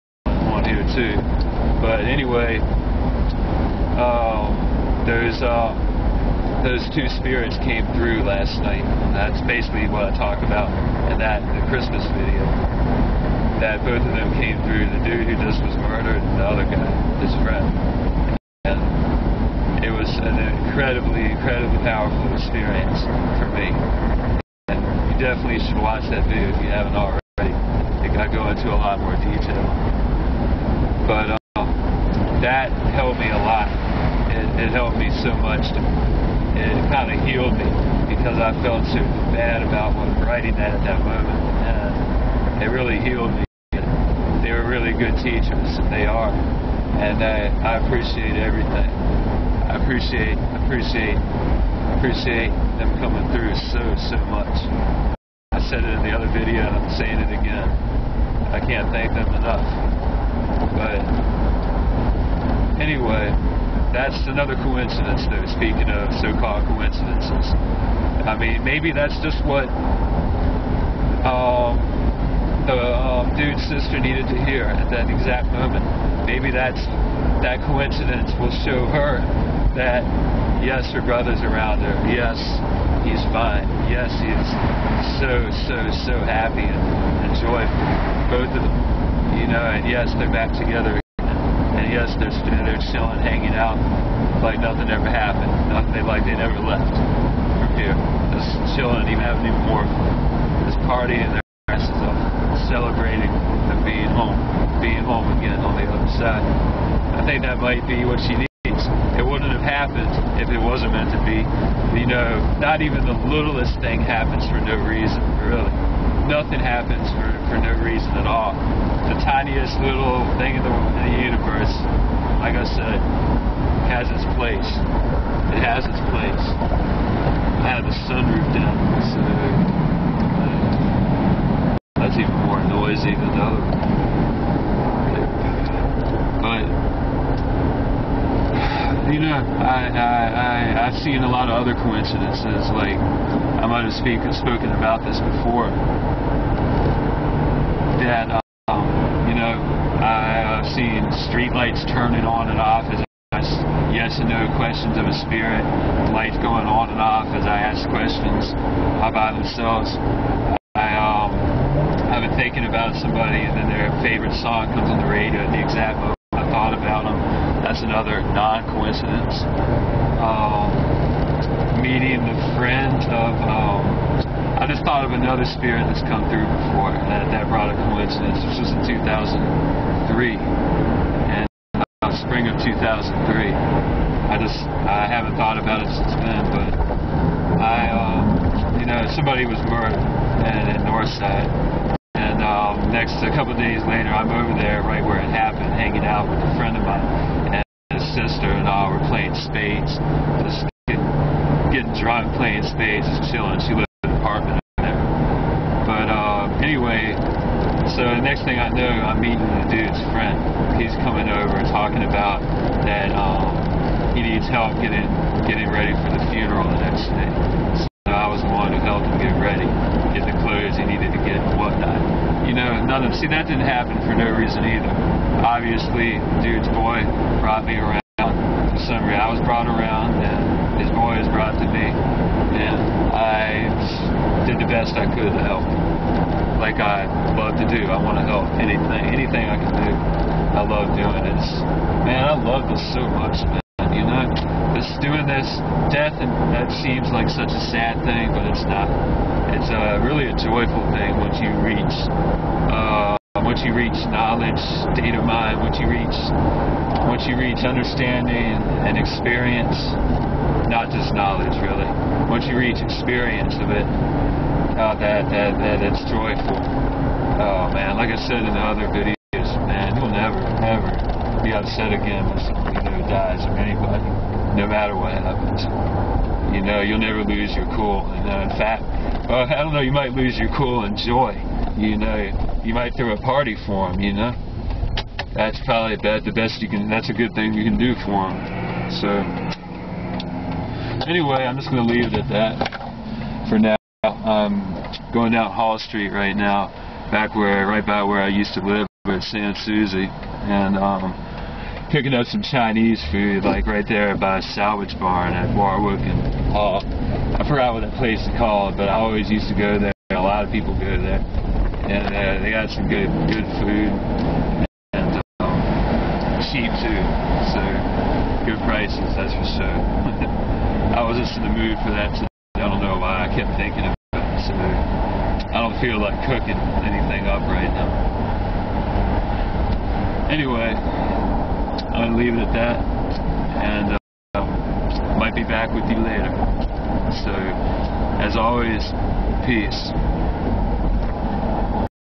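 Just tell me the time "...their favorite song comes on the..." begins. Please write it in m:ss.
2:43.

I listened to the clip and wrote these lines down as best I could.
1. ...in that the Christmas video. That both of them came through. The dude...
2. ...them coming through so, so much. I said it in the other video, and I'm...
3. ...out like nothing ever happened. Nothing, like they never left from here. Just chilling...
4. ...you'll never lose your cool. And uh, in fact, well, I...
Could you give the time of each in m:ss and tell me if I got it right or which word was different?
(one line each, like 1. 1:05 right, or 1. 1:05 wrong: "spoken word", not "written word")
1. 0:11 right
2. 0:52 right
3. 1:33 right
4. 4:36 right.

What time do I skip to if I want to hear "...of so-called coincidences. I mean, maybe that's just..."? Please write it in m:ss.
1:05.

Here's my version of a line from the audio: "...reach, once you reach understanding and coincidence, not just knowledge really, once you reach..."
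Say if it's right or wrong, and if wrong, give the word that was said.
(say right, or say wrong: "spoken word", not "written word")
wrong: "experience", not "coincidence".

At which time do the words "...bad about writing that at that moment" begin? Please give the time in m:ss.
0:39.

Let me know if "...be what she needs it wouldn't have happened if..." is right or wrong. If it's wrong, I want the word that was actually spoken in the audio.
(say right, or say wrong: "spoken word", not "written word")
right.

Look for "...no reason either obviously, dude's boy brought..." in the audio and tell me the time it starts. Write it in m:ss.
3:44.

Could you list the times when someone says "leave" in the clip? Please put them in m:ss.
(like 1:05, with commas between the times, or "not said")
4:51, 5:32.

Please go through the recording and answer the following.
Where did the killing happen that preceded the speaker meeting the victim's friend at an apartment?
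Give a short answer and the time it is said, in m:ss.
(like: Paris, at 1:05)
Northside, at 3:10.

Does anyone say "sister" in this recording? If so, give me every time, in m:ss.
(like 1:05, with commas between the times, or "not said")
1:13, 3:18.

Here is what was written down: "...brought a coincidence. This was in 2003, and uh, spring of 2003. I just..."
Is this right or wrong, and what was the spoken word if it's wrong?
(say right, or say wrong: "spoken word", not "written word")
right.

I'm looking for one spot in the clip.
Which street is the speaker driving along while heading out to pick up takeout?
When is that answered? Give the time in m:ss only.
4:55.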